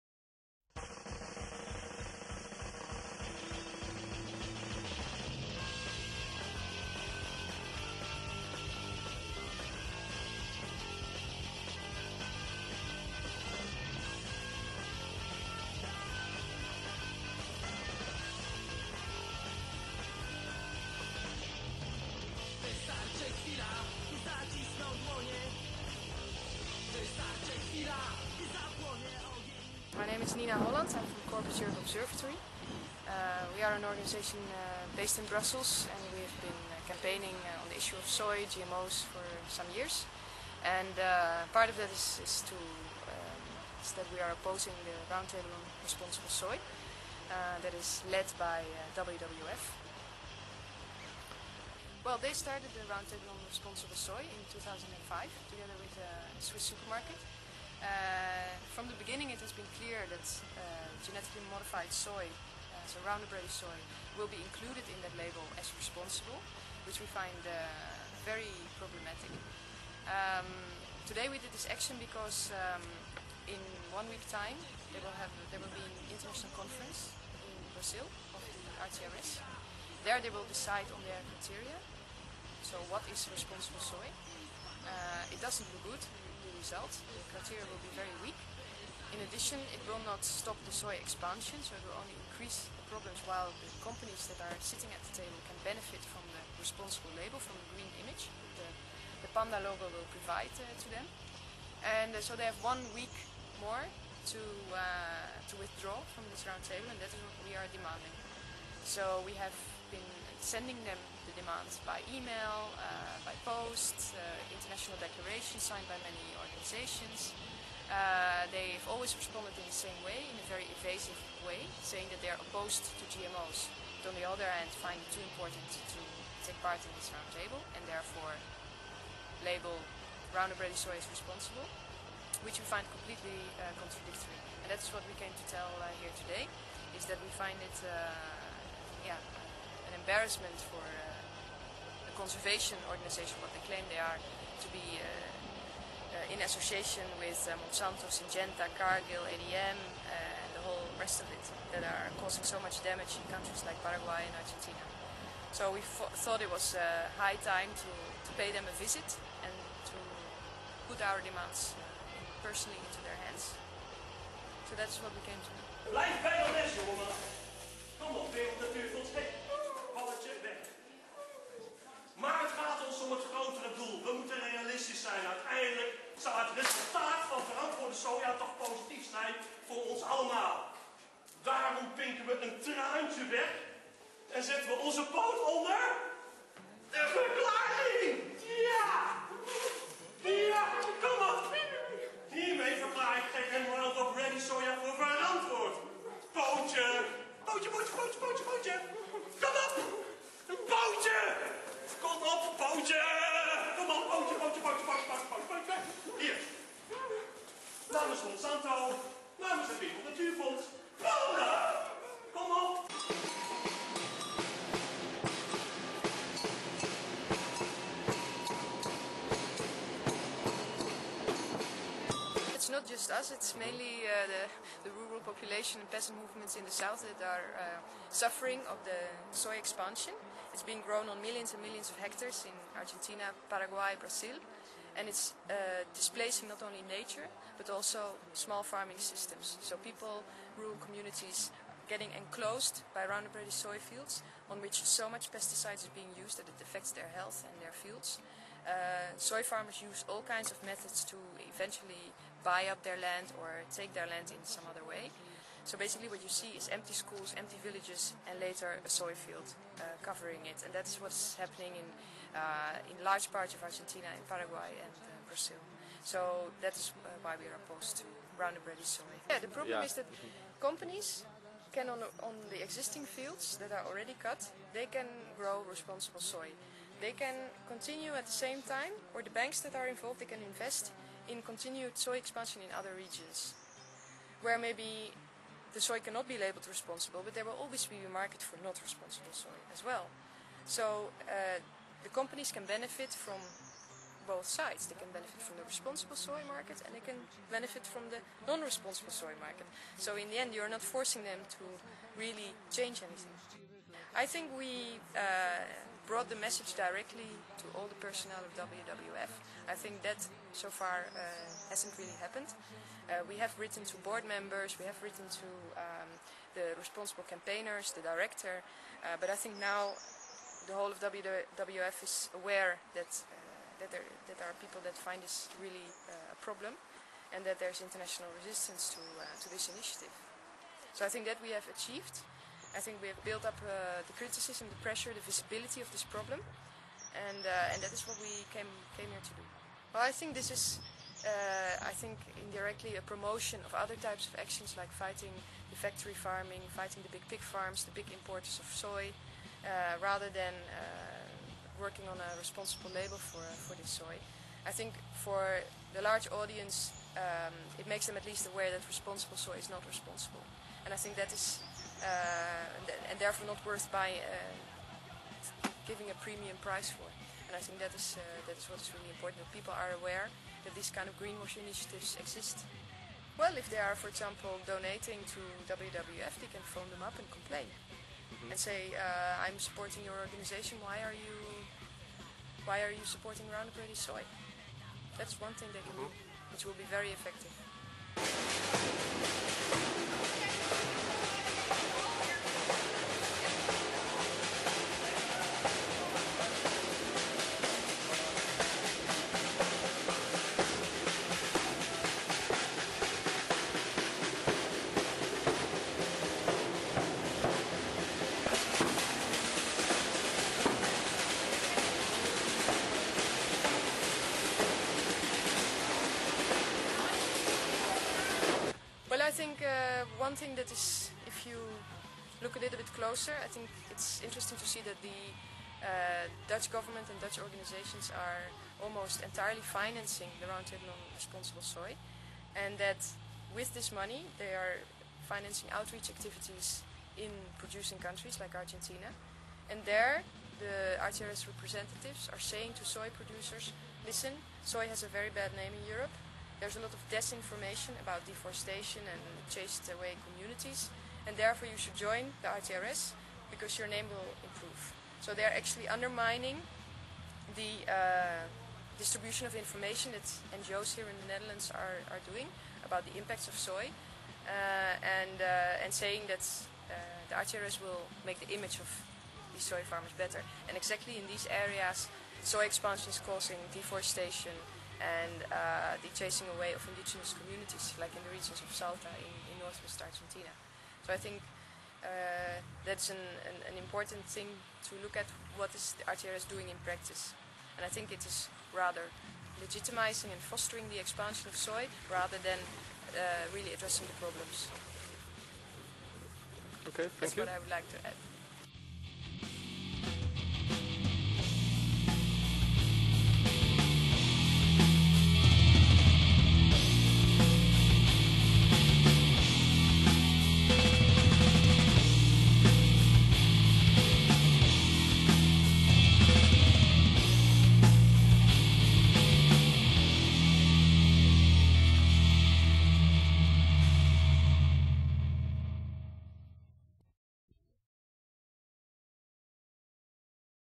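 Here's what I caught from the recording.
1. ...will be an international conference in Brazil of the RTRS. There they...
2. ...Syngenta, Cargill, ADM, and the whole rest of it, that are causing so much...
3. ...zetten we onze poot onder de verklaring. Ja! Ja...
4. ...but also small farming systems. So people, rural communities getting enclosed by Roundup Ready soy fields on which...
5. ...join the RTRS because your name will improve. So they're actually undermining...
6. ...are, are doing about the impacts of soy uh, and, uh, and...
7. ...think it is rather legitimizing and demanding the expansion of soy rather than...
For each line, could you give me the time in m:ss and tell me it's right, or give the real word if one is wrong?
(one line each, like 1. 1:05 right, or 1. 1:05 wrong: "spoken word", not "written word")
1. 1:15 right
2. 2:28 right
3. 3:04 right
4. 3:57 right
5. 7:31 right
6. 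7:41 right
7. 8:07 wrong: "fostering", not "demanding".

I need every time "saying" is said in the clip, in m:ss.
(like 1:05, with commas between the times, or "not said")
2:01, 7:22, 7:45.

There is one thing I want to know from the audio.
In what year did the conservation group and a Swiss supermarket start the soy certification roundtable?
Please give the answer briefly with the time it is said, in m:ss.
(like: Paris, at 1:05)
2005, at 0:54.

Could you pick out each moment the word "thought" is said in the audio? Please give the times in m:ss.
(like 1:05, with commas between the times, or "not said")
2:35.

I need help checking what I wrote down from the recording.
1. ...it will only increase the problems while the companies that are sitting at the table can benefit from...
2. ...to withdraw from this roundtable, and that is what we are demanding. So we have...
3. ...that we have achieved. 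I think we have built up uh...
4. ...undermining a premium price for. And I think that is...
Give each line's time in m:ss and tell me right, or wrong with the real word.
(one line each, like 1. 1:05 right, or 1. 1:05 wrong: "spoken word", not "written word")
1. 1:31 right
2. 1:45 right
3. 5:31 right
4. 6:05 wrong: "giving", not "undermining".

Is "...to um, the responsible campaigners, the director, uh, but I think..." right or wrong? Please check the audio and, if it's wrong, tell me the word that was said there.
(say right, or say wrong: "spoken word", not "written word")
right.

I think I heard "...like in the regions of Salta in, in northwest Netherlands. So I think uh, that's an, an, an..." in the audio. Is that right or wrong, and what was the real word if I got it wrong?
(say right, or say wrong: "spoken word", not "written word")
wrong: "Argentina", not "Netherlands".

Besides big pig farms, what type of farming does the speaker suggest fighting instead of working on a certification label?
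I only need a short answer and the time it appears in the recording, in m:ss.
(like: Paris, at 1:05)
Factory farming, at 5:45.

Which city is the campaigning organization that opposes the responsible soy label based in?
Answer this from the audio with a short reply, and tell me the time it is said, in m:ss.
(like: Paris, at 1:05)
Brussels, at 0:35.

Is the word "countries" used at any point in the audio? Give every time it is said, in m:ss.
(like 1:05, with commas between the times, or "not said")
2:33, 7:17.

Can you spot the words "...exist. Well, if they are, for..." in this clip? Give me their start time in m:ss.
6:12.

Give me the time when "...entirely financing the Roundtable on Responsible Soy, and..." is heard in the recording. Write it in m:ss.
7:09.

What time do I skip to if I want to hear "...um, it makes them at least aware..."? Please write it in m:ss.
5:57.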